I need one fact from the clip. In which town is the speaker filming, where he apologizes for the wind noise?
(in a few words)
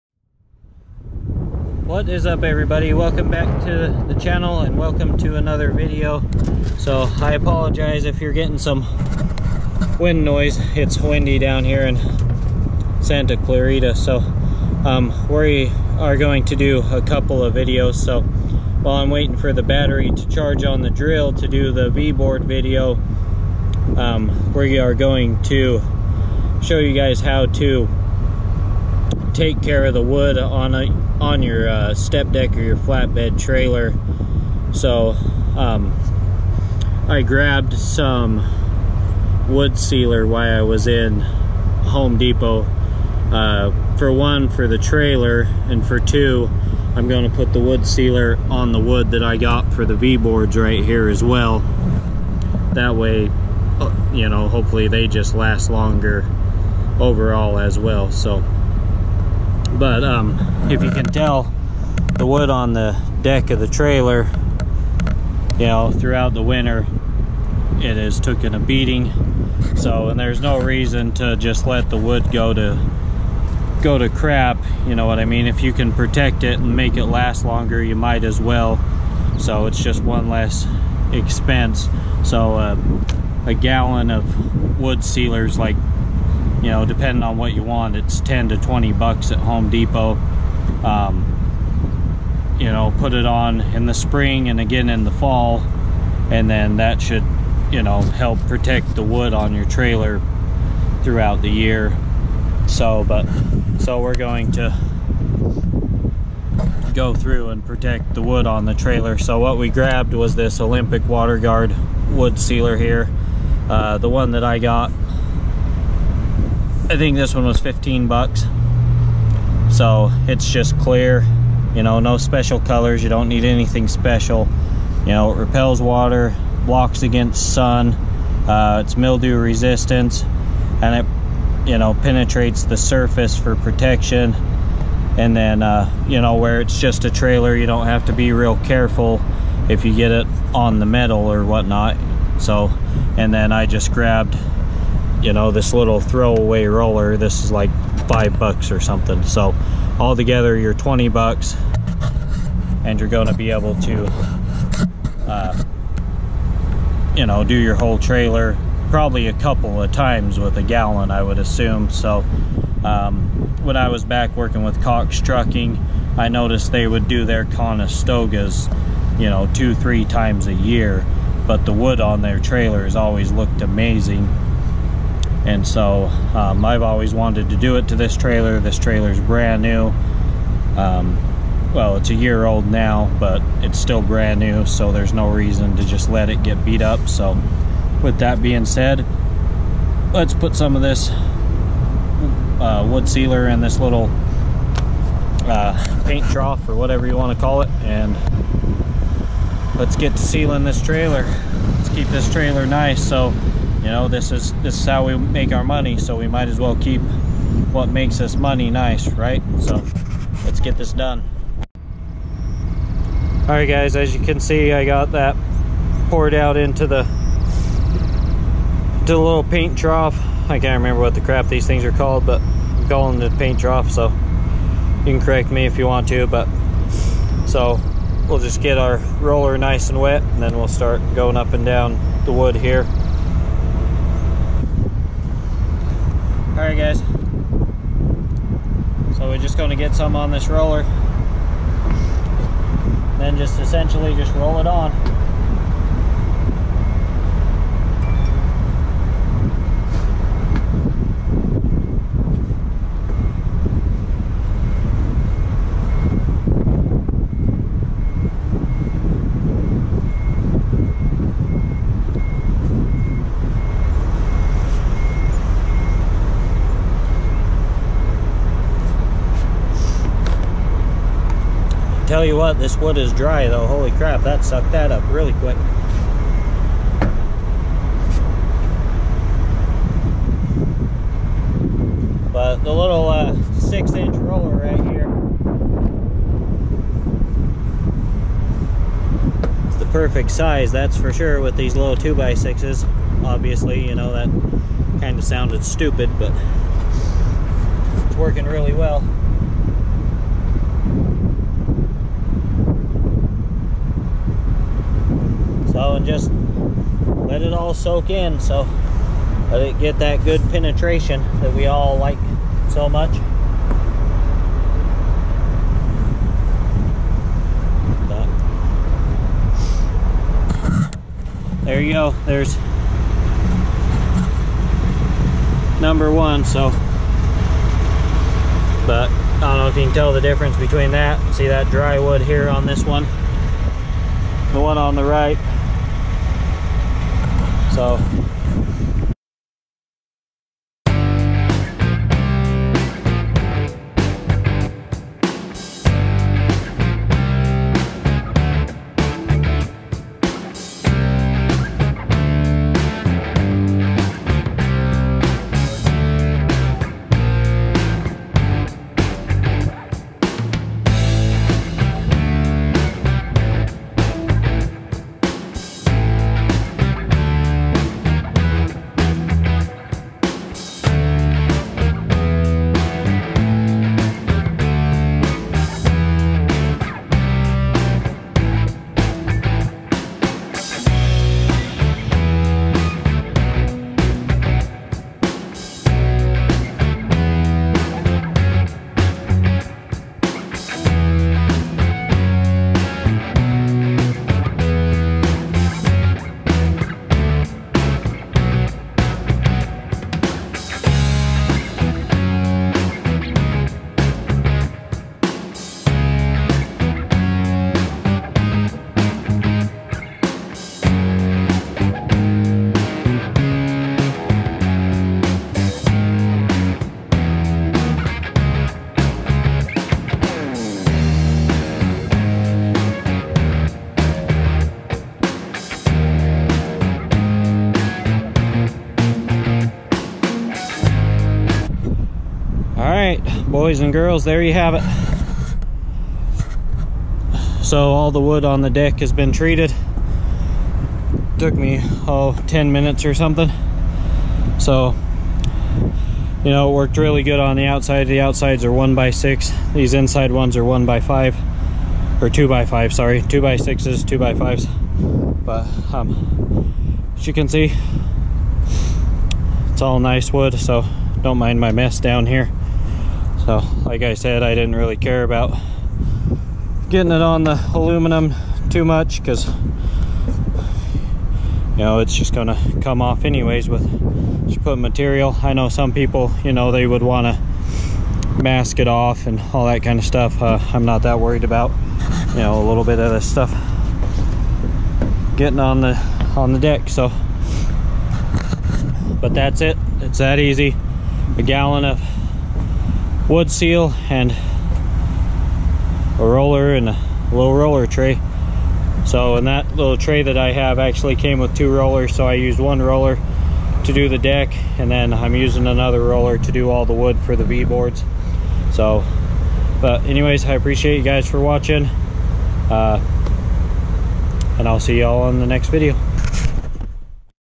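Santa Clarita.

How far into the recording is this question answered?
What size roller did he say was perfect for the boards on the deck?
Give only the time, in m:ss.
4:43.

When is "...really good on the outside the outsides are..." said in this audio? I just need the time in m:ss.
7:26.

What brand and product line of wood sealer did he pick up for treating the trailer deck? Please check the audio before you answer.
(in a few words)
Olympic WaterGuard.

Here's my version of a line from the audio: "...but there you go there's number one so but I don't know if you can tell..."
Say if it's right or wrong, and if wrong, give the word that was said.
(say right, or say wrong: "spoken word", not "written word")
right.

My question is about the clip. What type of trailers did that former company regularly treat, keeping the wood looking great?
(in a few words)
Conestogas.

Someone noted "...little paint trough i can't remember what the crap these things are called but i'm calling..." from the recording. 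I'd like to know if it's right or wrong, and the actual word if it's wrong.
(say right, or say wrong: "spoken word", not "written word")
right.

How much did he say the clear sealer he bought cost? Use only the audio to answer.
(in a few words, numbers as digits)
$15.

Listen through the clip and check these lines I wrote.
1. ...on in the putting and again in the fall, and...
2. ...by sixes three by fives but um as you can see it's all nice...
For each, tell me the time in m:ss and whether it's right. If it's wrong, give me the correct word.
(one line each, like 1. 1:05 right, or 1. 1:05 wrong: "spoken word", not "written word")
1. 1:33 wrong: "spring", not "putting"
2. 7:33 wrong: "two", not "three".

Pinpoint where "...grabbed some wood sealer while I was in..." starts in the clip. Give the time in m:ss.
0:37.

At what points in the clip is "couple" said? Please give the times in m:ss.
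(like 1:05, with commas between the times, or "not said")
0:17, 2:39.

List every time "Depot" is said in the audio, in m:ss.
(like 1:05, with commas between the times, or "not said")
0:42, 1:29.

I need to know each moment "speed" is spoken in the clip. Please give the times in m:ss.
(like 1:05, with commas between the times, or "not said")
not said.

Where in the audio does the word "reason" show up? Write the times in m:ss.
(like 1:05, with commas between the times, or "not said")
1:10, 3:05.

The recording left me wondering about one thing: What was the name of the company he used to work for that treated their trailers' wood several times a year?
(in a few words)
Cox Trucking.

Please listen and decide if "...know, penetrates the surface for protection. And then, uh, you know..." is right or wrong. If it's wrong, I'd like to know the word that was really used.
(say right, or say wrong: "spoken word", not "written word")
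right.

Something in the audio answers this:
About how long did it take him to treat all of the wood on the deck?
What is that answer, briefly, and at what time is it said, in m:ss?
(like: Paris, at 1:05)
10 minutes, at 7:22.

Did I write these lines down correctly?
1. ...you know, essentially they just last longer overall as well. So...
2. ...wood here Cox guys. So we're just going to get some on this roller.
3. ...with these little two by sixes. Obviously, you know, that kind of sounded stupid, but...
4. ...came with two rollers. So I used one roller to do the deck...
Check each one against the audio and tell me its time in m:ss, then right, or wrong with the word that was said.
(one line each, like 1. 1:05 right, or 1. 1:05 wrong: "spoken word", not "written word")
1. 0:54 wrong: "hopefully", not "essentially"
2. 3:52 wrong: "Alright", not "Cox"
3. 4:51 right
4. 8:21 right.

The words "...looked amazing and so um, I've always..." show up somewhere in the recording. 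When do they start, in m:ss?
2:53.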